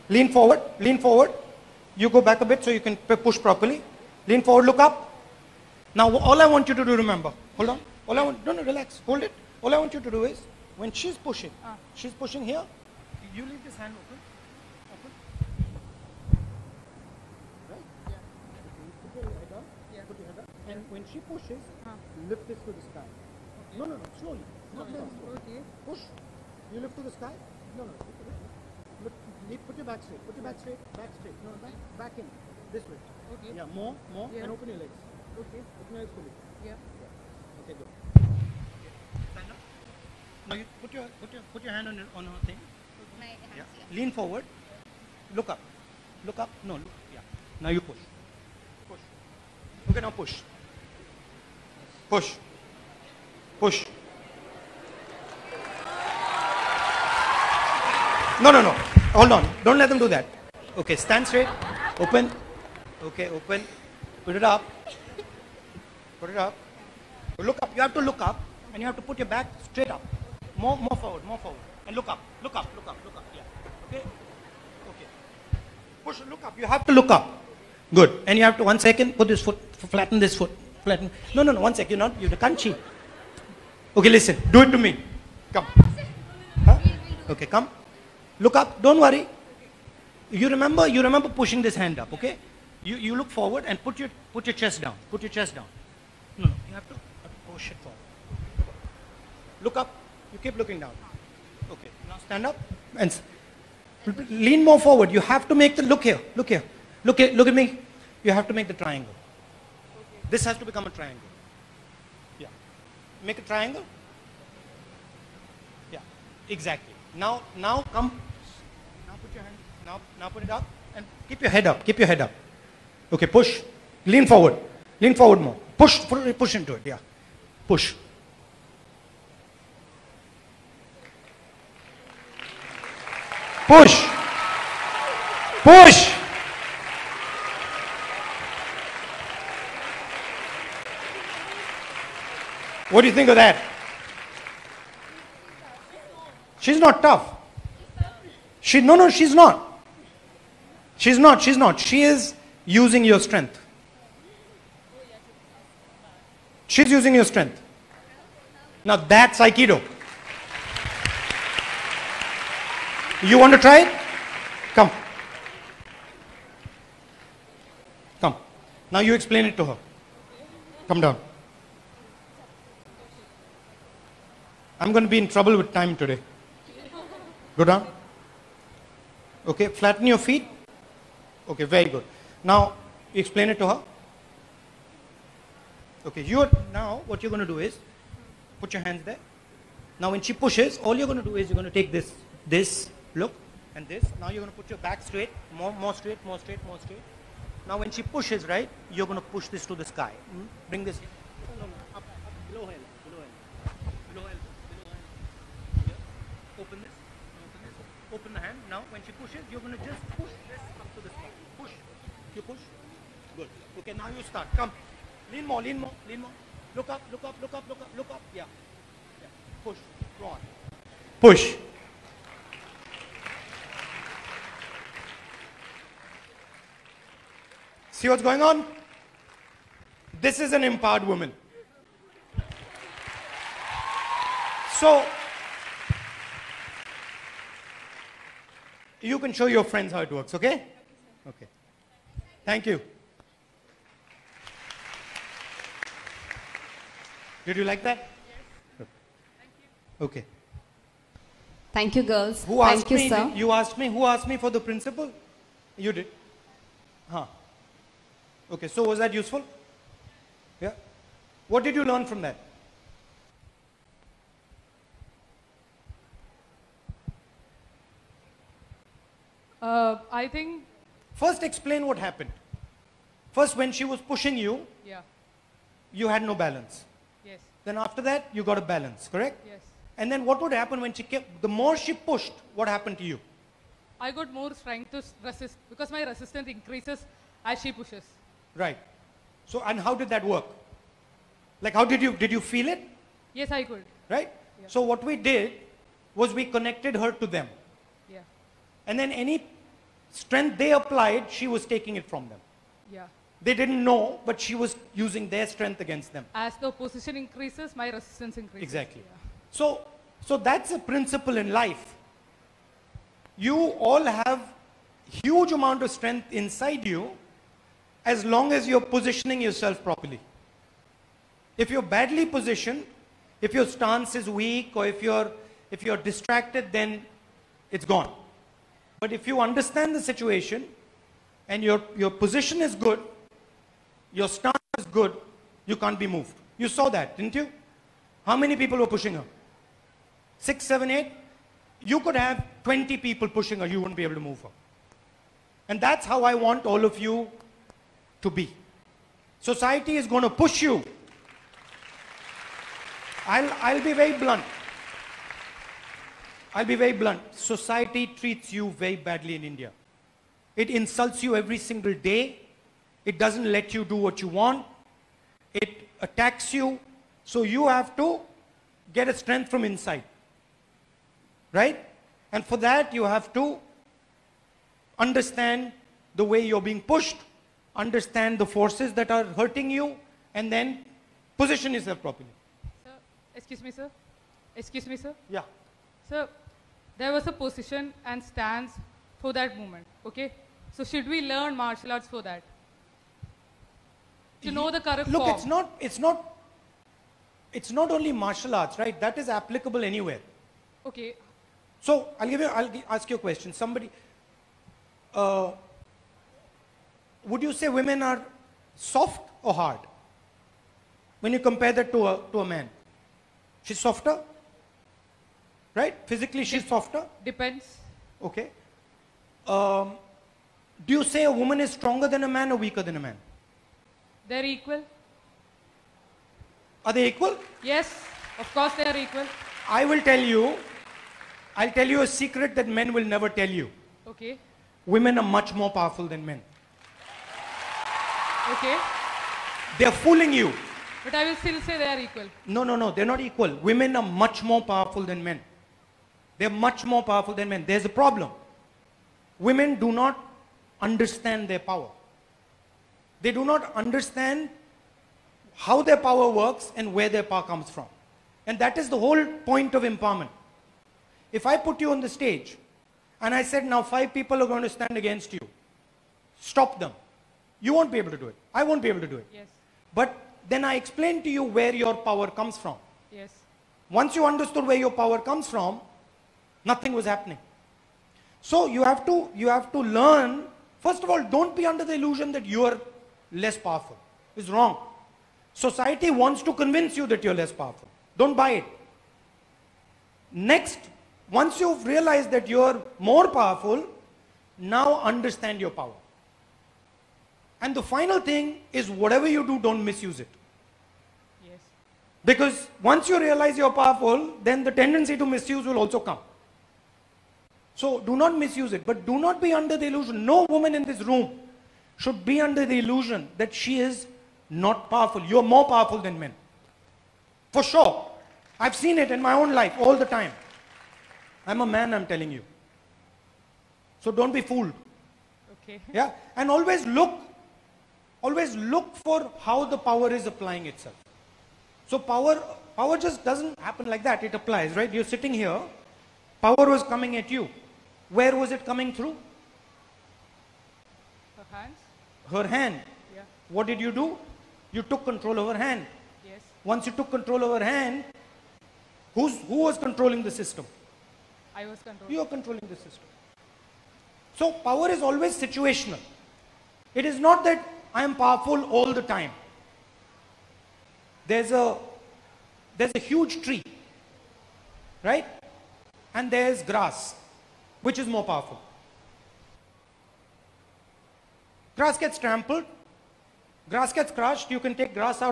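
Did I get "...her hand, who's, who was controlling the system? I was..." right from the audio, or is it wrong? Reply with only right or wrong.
right.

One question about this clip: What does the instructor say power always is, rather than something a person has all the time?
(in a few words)
Situational.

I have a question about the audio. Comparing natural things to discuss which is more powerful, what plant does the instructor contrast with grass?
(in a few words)
A huge tree.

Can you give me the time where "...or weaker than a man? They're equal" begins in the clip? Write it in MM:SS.
07:02.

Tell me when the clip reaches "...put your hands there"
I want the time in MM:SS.
03:08.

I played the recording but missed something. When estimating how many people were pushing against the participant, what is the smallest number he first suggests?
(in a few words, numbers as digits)
6.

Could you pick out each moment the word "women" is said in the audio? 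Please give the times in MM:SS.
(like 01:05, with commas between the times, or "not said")
06:47, 07:14, 07:23, 07:29.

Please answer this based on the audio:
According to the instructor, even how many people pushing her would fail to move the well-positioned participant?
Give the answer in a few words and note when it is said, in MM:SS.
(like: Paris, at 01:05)
20, at 05:42.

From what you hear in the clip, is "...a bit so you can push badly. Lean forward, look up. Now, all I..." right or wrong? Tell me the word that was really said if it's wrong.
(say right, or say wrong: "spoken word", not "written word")
wrong: "properly", not "badly".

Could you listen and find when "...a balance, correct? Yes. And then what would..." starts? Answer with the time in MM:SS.
04:38.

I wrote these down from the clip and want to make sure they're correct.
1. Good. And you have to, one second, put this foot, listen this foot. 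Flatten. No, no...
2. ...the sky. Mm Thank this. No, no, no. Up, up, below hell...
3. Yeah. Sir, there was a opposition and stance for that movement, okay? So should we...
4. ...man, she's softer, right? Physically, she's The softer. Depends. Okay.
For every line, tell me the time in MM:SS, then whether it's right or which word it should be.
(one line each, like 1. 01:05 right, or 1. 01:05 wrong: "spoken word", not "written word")
1. 01:17 wrong: "flatten", not "listen"
2. 03:19 wrong: "Bring", not "Thank"
3. 06:25 wrong: "position", not "opposition"
4. 06:52 wrong: "Dep", not "The".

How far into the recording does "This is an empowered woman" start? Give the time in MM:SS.
03:50.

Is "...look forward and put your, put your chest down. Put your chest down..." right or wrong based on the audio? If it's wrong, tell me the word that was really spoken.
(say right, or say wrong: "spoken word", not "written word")
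right.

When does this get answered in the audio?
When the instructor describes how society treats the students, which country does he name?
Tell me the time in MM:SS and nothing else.
05:59.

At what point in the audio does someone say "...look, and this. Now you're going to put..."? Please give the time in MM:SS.
03:13.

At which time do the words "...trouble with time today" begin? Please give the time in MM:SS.
02:55.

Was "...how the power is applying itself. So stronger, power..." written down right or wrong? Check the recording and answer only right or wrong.
wrong.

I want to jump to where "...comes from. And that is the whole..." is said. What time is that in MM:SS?
07:37.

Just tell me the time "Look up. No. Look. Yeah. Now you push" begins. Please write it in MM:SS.
00:46.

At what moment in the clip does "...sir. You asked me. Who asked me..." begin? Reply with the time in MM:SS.
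04:13.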